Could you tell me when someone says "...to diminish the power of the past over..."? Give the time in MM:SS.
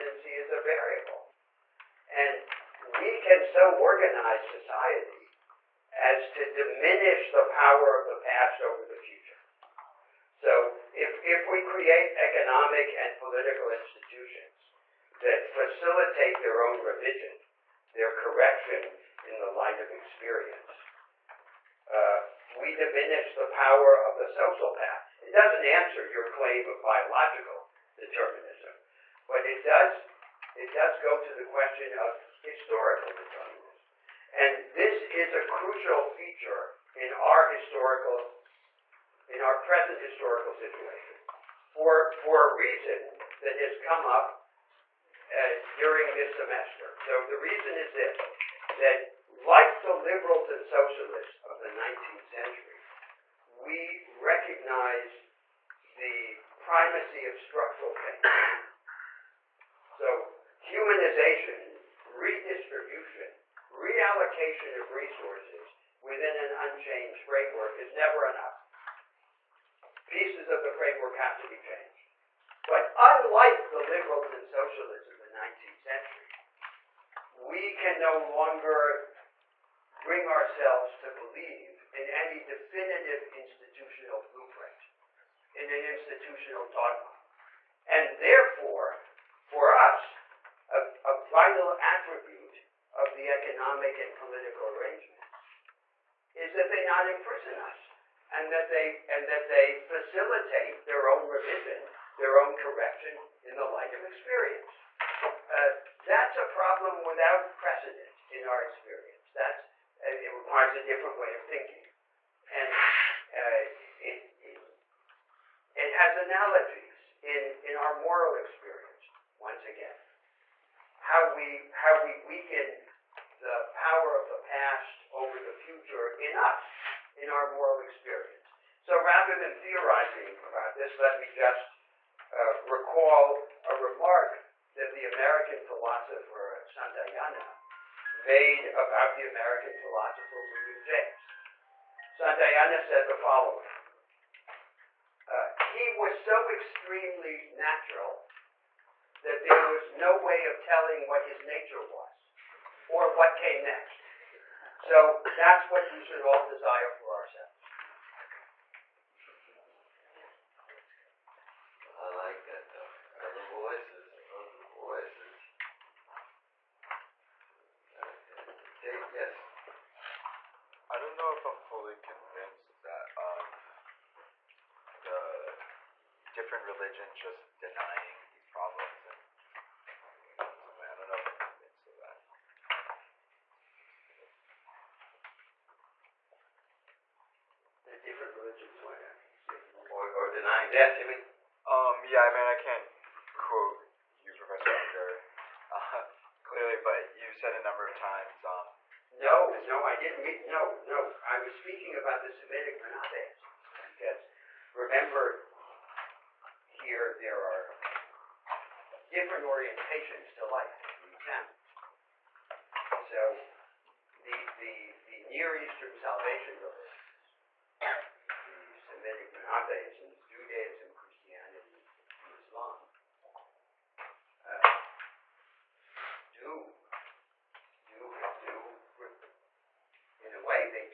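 00:06.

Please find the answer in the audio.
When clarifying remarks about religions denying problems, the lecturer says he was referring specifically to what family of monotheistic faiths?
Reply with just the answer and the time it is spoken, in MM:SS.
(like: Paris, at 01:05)
Semitic monotheism, at 03:22.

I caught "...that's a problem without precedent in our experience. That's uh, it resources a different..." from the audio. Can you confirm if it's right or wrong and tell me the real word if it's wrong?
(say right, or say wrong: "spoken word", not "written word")
wrong: "requires", not "resources".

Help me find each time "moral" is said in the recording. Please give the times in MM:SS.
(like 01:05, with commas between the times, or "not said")
01:57, 02:07.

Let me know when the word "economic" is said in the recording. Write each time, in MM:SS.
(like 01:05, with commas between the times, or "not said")
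00:12, 01:33.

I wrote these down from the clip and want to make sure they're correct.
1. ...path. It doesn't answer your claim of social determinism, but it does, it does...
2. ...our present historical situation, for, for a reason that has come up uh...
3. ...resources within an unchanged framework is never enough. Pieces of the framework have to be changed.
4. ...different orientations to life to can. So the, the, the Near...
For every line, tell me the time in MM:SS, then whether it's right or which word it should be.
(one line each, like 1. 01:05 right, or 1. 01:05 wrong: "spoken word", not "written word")
1. 00:24 wrong: "biological", not "social"
2. 00:39 right
3. 01:04 right
4. 03:29 right.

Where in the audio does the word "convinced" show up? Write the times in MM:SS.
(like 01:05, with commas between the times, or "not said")
02:51, 03:01.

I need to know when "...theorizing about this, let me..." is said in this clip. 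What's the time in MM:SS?
02:09.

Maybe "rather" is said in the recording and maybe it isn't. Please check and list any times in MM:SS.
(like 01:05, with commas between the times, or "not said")
02:09.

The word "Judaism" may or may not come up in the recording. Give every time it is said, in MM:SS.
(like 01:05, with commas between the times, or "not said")
03:40.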